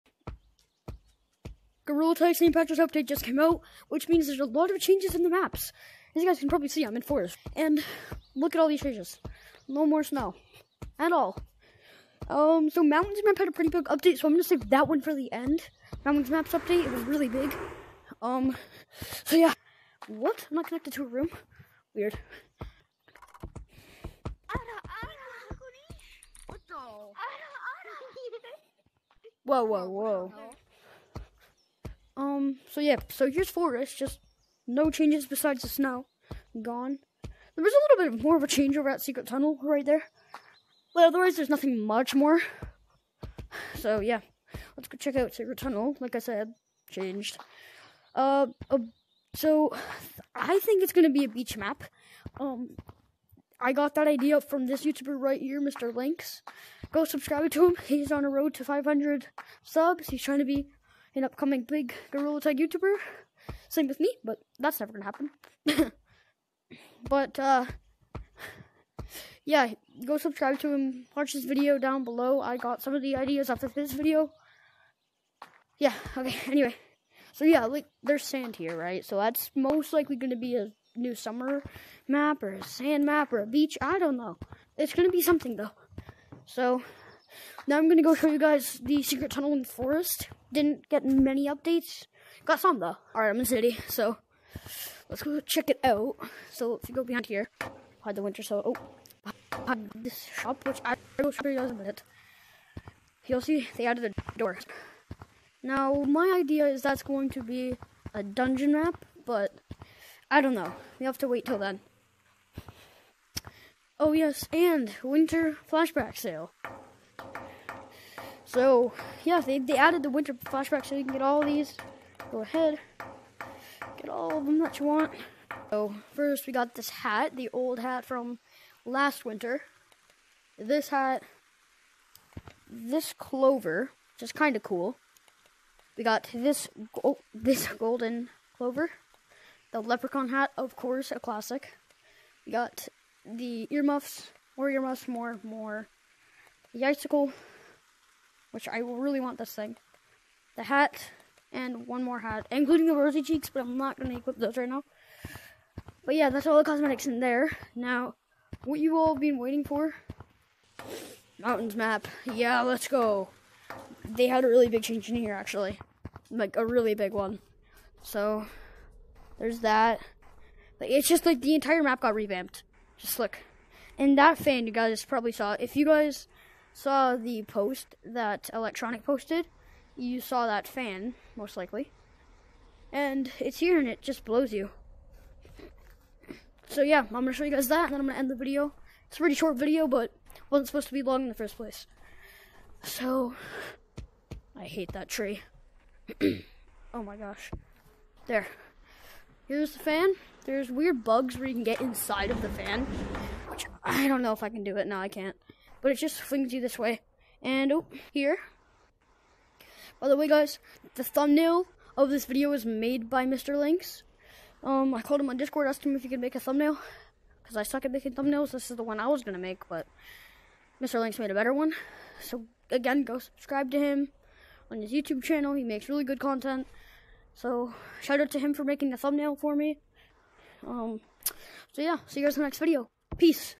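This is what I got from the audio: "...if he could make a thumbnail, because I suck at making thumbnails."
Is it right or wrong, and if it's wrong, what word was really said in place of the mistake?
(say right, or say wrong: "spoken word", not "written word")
right.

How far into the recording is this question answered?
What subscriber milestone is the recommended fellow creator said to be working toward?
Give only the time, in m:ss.
0:58.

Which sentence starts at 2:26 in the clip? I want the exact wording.
The icicle, which I really want this thing.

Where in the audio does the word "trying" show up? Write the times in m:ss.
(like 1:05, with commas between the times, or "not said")
1:00.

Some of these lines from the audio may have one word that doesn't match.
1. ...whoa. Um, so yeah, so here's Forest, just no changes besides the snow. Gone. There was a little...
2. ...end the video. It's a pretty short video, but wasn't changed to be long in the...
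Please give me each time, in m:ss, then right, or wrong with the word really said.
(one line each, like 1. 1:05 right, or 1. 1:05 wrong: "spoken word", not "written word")
1. 0:29 right
2. 3:08 wrong: "supposed", not "changed".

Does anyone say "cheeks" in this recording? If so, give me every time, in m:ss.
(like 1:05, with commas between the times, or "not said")
2:33.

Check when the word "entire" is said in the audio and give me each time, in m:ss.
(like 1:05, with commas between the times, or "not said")
2:51.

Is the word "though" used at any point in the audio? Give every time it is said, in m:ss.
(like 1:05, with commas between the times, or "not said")
1:25, 1:32.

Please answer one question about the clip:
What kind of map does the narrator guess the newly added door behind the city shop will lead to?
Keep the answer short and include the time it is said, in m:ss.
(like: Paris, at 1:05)
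A dungeon map, at 1:48.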